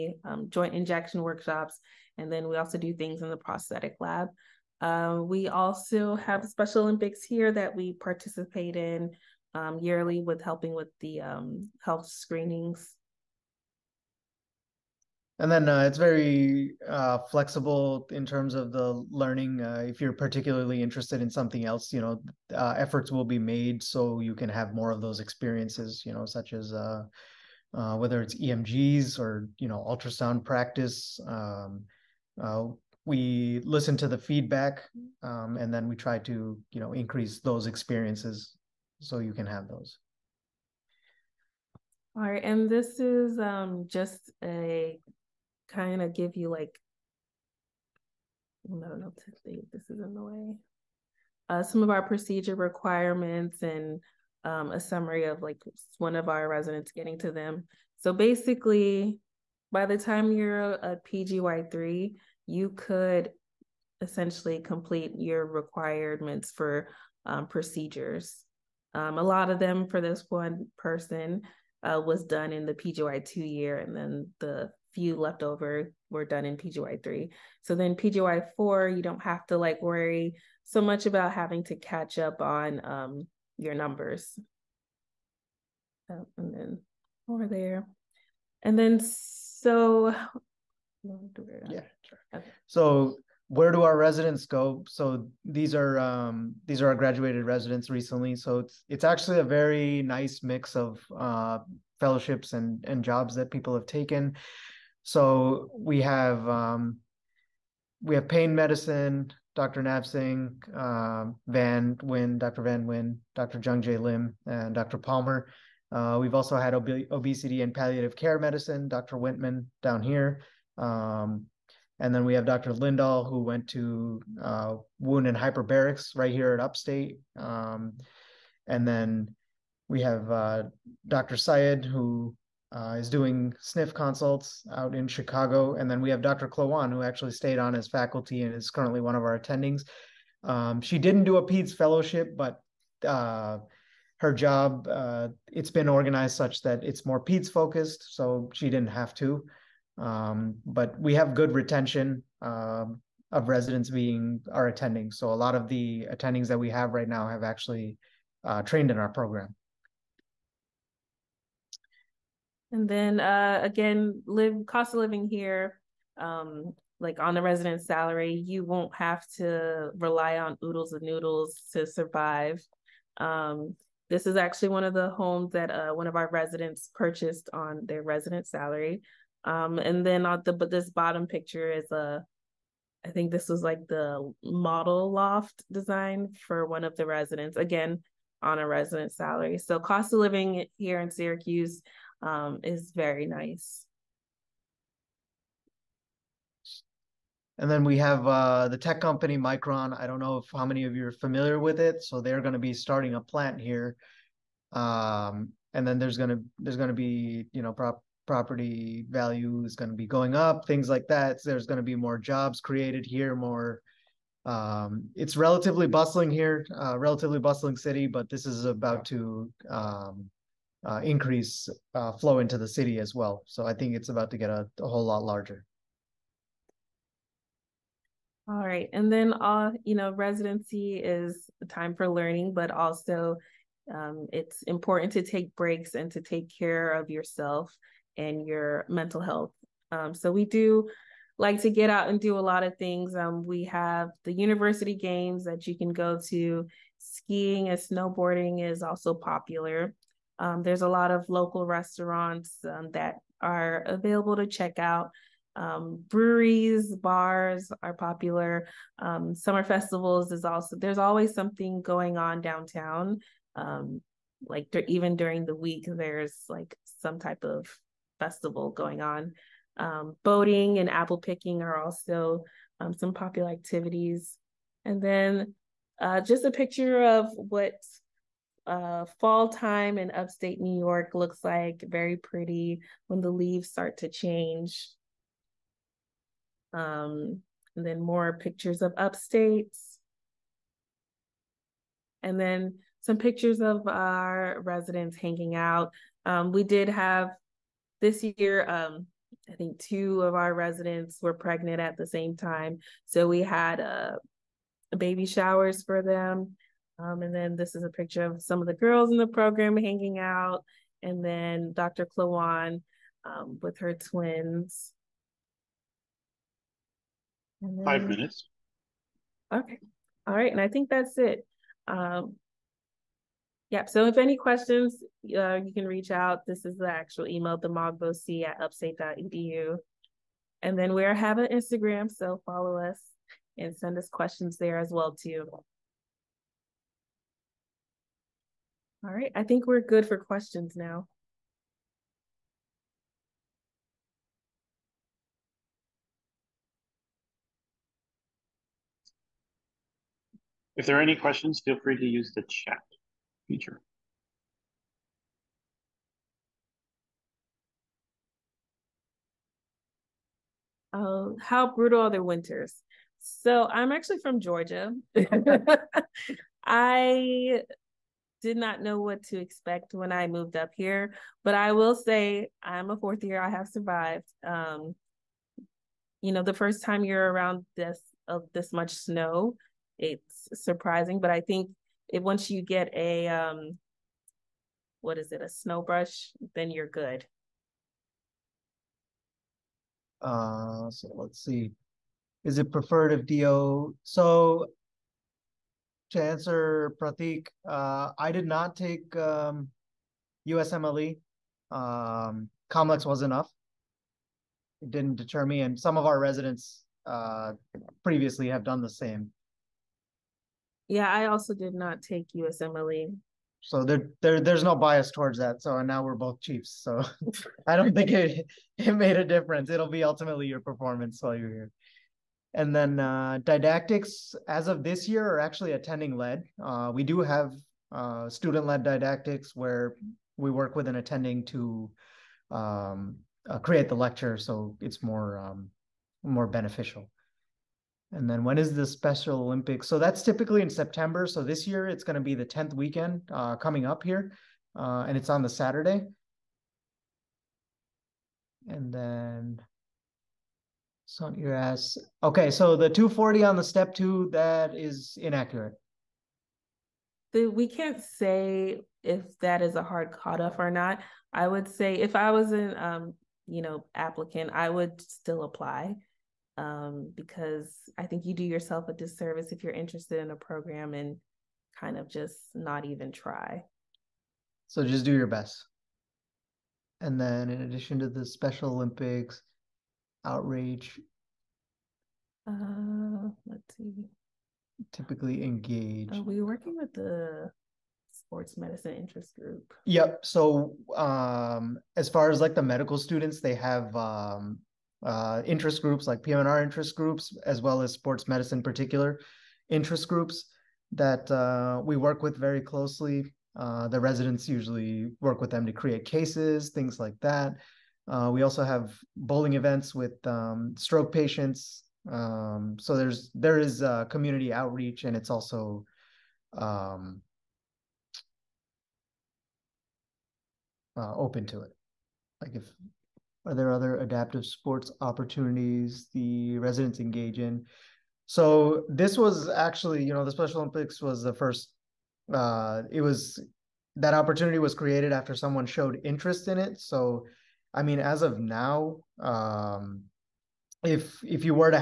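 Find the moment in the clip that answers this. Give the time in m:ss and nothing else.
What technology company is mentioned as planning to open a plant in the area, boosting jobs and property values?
3:19.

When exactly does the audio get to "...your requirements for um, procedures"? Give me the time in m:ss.
1:05.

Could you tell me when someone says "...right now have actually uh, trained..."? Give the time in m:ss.
2:36.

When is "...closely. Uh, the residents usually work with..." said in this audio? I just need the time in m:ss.
8:22.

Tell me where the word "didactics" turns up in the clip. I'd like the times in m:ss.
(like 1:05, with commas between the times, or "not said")
7:03, 7:08.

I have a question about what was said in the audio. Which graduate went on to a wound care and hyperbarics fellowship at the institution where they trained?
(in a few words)
Dr. Lindahl.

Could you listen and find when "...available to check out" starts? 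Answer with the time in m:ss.
4:13.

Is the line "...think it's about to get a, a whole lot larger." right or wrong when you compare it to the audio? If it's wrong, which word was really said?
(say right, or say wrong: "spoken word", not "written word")
right.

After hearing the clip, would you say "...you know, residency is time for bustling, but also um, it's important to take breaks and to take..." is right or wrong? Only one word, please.
wrong.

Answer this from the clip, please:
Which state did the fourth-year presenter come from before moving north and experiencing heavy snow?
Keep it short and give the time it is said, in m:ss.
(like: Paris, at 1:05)
Georgia, at 6:04.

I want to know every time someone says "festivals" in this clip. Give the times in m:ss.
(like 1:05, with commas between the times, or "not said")
4:19, 4:28.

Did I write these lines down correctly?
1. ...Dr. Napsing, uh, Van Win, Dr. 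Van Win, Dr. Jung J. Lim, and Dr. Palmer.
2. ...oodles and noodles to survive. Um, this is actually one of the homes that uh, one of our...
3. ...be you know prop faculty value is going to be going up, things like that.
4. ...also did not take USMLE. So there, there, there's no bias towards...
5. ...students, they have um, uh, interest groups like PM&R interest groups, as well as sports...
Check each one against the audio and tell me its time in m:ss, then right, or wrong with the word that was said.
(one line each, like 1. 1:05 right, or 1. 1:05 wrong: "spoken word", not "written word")
1. 1:49 right
2. 2:50 right
3. 3:26 wrong: "property", not "faculty"
4. 6:51 right
5. 8:12 right.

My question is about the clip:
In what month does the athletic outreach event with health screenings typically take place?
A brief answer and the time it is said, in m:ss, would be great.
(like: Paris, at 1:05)
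September, at 7:20.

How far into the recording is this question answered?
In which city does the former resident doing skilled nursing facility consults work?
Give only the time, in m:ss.
2:15.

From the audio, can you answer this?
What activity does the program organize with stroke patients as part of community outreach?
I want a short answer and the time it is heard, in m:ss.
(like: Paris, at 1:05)
Bowling events, at 8:29.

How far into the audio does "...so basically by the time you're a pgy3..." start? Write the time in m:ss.
0:57.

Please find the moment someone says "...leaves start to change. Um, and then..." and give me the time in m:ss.
4:43.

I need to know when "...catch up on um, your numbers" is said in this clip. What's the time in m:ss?
1:21.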